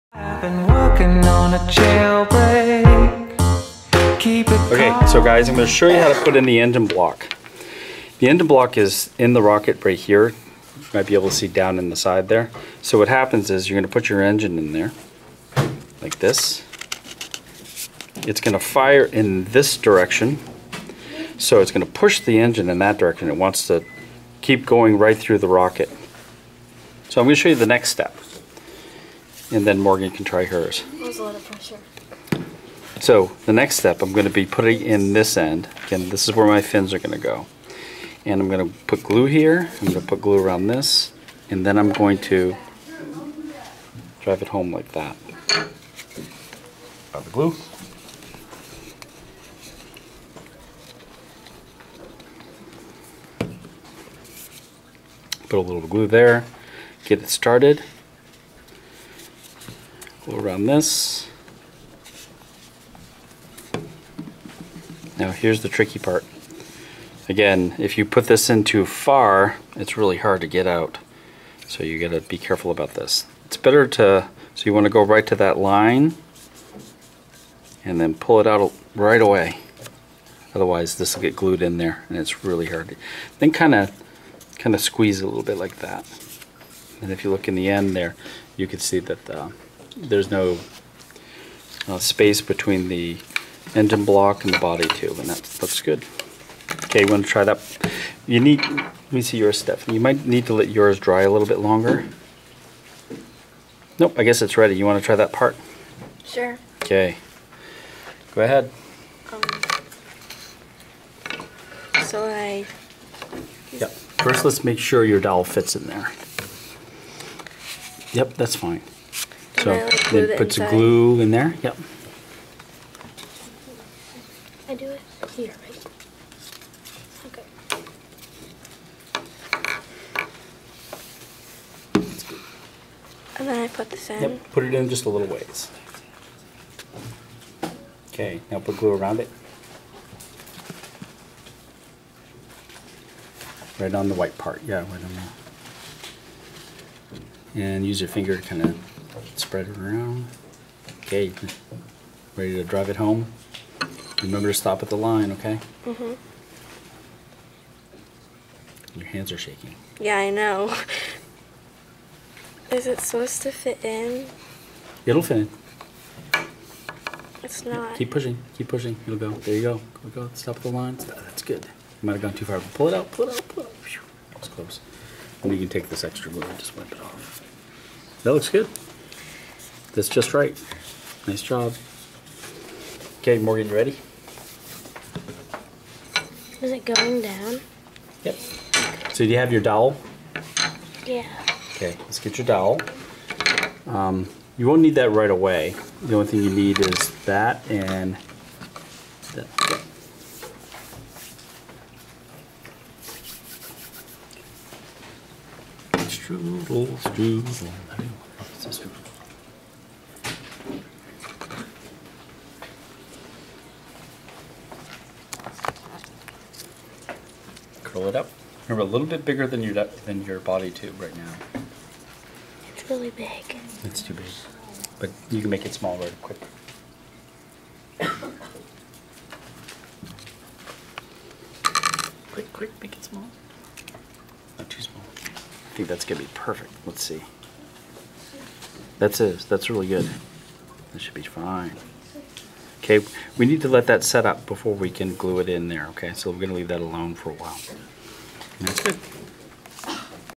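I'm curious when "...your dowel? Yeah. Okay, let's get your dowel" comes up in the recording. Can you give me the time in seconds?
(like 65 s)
189 s.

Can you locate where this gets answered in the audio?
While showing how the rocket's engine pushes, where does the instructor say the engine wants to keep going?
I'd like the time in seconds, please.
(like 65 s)
24 s.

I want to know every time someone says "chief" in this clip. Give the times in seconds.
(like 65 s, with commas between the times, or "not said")
not said.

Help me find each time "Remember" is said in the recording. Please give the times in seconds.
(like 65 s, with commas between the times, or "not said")
154 s, 218 s.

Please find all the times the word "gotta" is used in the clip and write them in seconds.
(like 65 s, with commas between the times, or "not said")
71 s.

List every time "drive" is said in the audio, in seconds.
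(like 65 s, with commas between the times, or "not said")
44 s, 152 s.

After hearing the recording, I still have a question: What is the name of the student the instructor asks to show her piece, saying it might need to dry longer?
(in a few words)
Stephanie.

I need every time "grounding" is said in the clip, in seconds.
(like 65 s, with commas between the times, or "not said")
not said.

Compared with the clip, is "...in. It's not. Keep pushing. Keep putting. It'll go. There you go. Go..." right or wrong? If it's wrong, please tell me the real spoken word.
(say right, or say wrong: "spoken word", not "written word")
wrong: "pushing", not "putting".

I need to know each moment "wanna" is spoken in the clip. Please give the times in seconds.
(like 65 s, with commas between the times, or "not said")
74 s.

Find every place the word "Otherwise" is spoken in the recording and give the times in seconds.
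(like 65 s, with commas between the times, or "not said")
80 s.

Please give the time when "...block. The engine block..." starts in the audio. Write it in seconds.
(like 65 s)
6 s.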